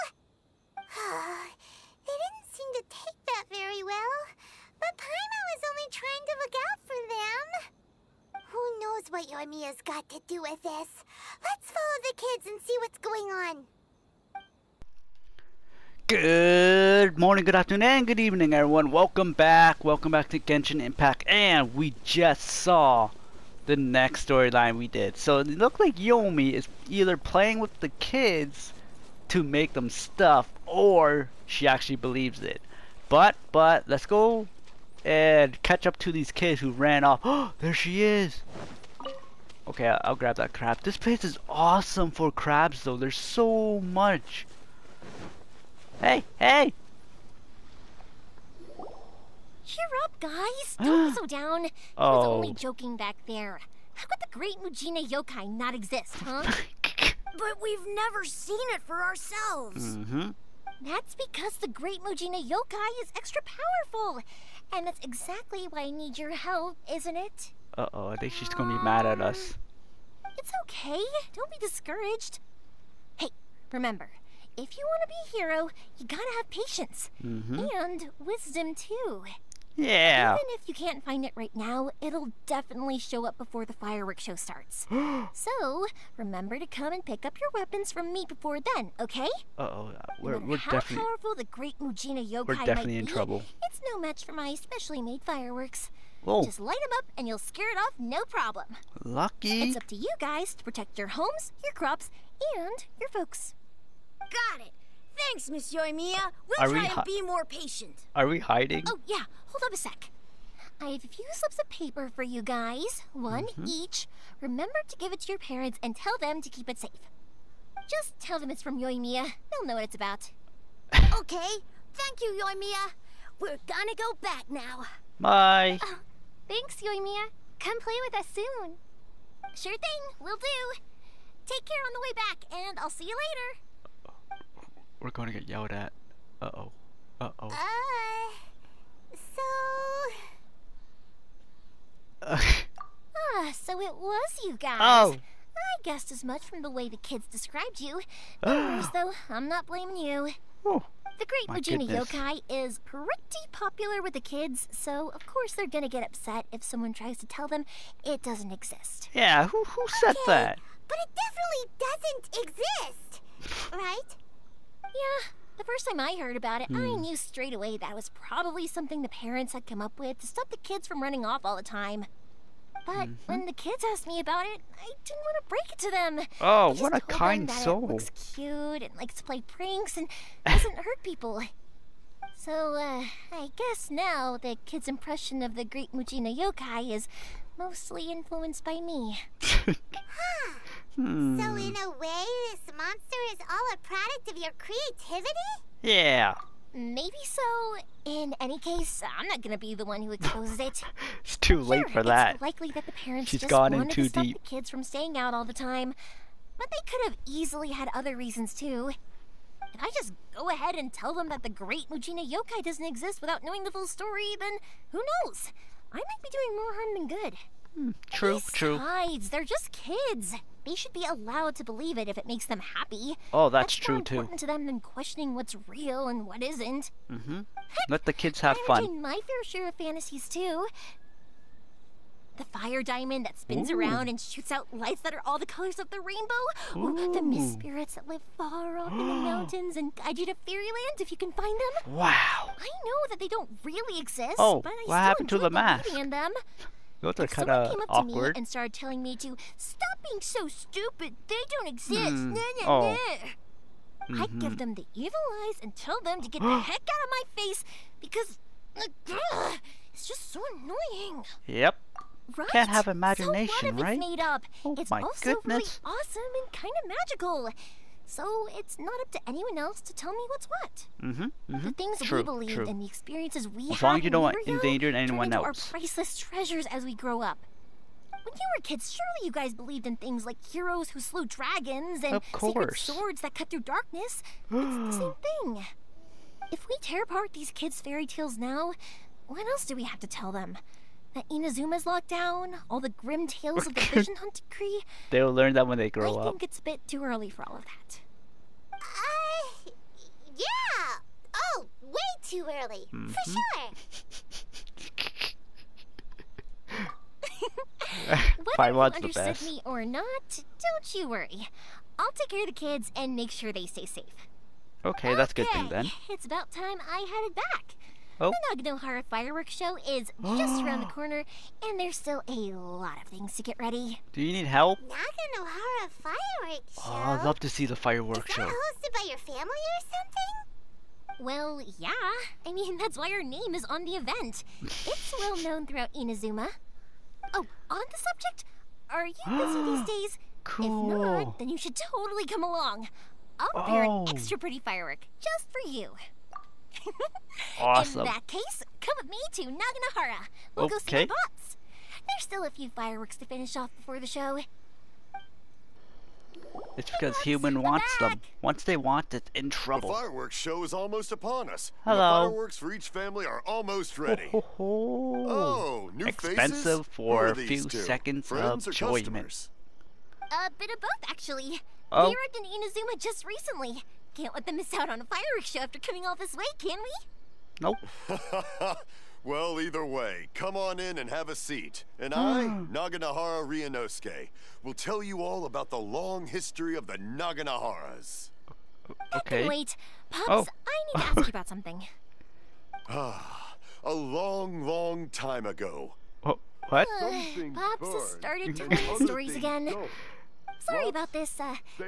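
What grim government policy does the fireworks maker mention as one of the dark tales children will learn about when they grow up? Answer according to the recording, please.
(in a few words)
Vision Hunt decree.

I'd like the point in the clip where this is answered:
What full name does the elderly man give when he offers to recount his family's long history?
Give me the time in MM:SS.
06:22.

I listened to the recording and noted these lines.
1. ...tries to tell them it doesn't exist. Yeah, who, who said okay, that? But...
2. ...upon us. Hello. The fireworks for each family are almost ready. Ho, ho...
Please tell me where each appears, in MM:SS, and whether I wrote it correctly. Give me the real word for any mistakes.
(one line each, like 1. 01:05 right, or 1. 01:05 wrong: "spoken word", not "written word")
1. 02:36 right
2. 06:01 right.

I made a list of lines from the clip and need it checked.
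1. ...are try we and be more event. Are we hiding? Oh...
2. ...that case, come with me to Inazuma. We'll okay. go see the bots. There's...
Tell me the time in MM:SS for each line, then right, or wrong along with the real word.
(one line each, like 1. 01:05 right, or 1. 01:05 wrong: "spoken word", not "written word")
1. 01:46 wrong: "patient", not "event"
2. 05:48 wrong: "Naganohara", not "Inazuma".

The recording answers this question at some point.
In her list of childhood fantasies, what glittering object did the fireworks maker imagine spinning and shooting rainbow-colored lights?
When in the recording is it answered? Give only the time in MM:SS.
03:52.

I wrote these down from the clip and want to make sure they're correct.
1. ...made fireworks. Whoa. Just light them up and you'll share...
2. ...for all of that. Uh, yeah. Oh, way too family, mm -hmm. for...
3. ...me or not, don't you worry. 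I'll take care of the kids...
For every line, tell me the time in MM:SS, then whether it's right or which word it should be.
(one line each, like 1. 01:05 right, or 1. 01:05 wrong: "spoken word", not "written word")
1. 01:35 wrong: "scare", not "share"
2. 04:57 wrong: "early", not "family"
3. 05:09 right.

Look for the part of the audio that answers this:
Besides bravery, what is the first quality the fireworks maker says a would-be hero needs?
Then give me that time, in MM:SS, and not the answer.
01:16.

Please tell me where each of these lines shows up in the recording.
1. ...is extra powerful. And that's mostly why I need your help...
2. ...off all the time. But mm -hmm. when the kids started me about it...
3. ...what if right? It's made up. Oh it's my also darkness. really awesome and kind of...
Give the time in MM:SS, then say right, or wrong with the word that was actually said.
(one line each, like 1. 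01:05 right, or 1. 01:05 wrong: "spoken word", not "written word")
1. 01:03 wrong: "exactly", not "mostly"
2. 02:51 wrong: "asked", not "started"
3. 04:23 wrong: "goodness", not "darkness".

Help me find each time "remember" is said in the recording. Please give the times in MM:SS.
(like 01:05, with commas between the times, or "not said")
01:13, 01:26, 01:54.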